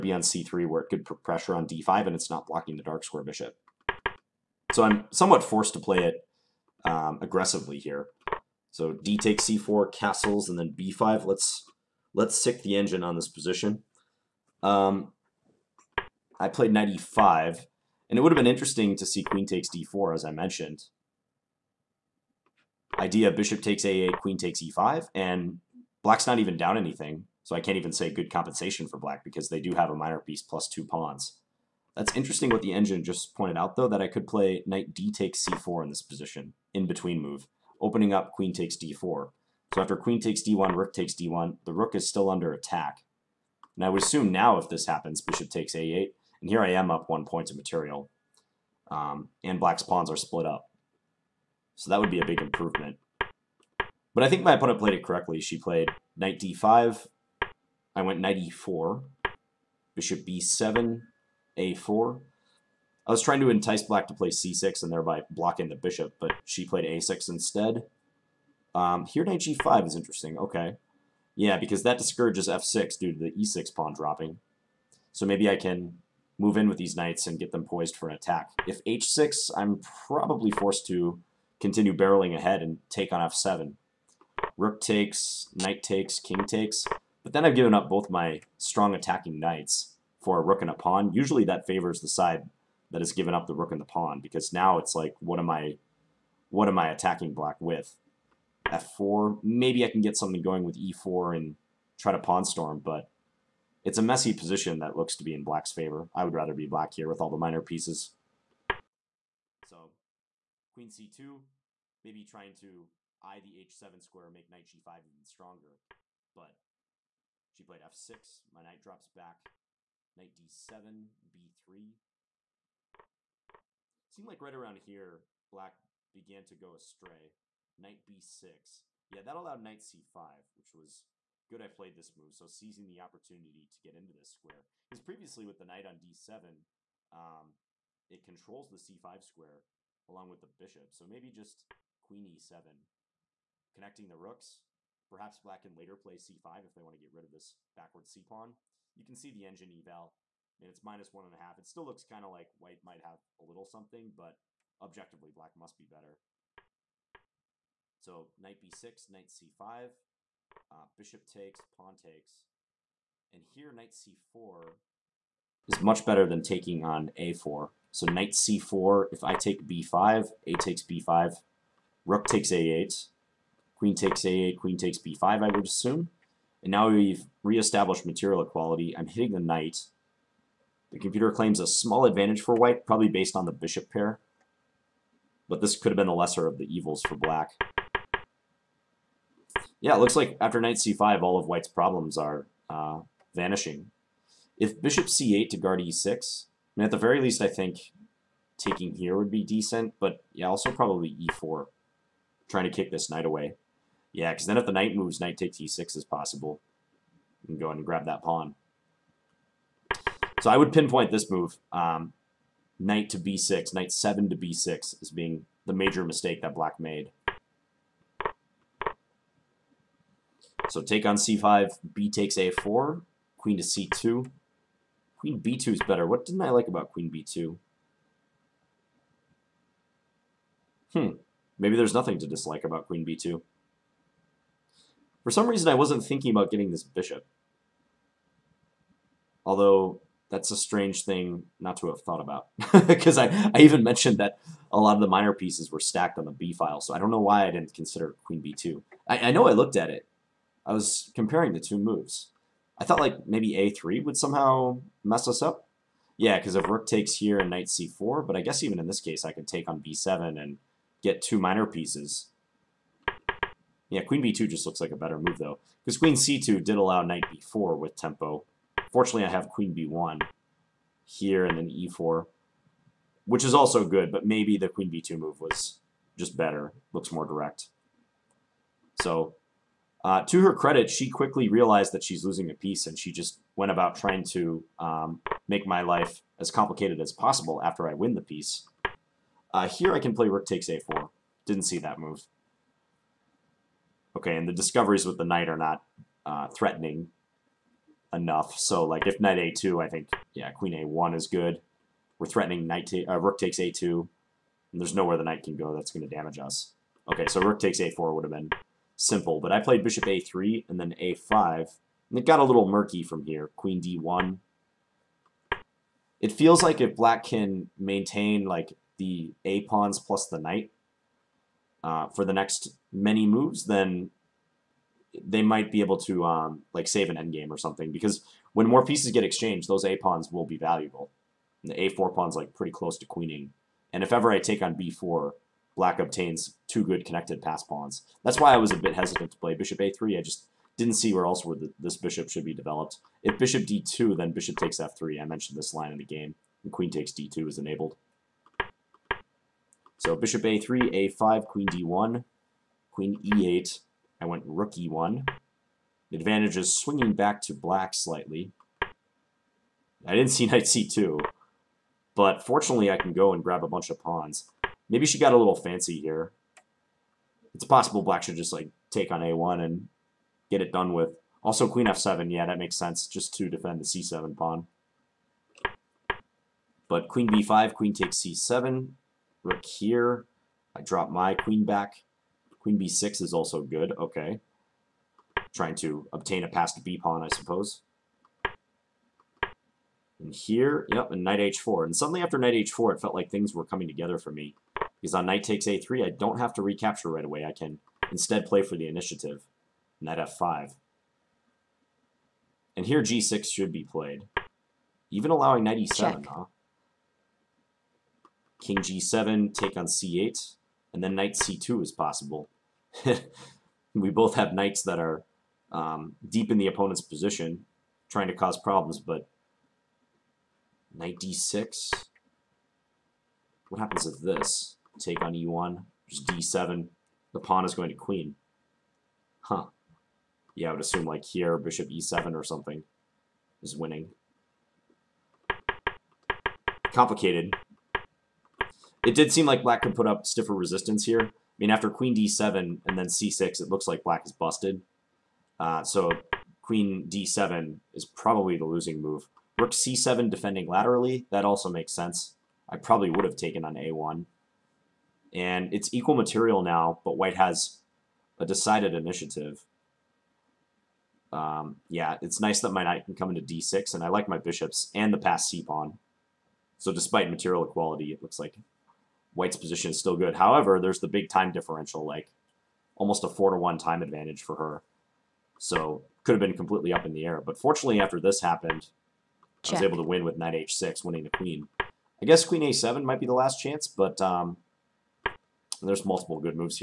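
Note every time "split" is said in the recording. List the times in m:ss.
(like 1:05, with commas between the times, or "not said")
0:50.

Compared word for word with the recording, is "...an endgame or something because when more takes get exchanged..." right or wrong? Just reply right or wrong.
wrong.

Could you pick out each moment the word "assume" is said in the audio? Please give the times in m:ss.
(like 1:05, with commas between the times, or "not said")
0:44, 2:55, 7:10.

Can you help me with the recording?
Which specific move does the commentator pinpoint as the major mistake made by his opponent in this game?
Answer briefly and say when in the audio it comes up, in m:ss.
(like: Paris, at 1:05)
Knight 7 to b6, at 3:33.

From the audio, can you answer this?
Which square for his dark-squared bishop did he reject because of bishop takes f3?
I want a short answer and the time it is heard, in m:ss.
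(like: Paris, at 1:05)
d2, at 5:43.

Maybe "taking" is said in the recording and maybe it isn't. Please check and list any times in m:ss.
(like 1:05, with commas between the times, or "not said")
2:46, 3:18.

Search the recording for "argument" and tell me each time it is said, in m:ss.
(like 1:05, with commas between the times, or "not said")
not said.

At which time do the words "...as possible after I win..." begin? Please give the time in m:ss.
4:46.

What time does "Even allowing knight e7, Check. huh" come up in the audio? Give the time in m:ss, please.
6:45.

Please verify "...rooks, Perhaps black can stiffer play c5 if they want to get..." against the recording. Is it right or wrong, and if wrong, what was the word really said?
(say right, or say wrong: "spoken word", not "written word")
wrong: "later", not "stiffer".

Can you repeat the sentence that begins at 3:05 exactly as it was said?
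But this could have been the lesser of the evils for black.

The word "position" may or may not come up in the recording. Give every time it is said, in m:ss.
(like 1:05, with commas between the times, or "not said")
0:13, 0:36, 1:44, 6:57, 7:49.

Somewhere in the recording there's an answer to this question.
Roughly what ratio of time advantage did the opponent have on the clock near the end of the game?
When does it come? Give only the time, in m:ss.
7:53.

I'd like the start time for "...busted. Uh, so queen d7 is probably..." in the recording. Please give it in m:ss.
7:24.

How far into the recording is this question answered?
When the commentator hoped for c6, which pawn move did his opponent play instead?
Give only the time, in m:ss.
1:06.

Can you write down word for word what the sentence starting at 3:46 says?
What didn't I like about queen b2?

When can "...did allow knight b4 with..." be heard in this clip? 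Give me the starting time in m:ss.
4:26.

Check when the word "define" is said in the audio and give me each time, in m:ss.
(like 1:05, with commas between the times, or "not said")
not said.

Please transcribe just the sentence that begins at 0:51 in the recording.
So that would be a big improvement.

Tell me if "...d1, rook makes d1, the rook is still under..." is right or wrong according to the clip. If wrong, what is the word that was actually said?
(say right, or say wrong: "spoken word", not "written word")
wrong: "takes", not "makes".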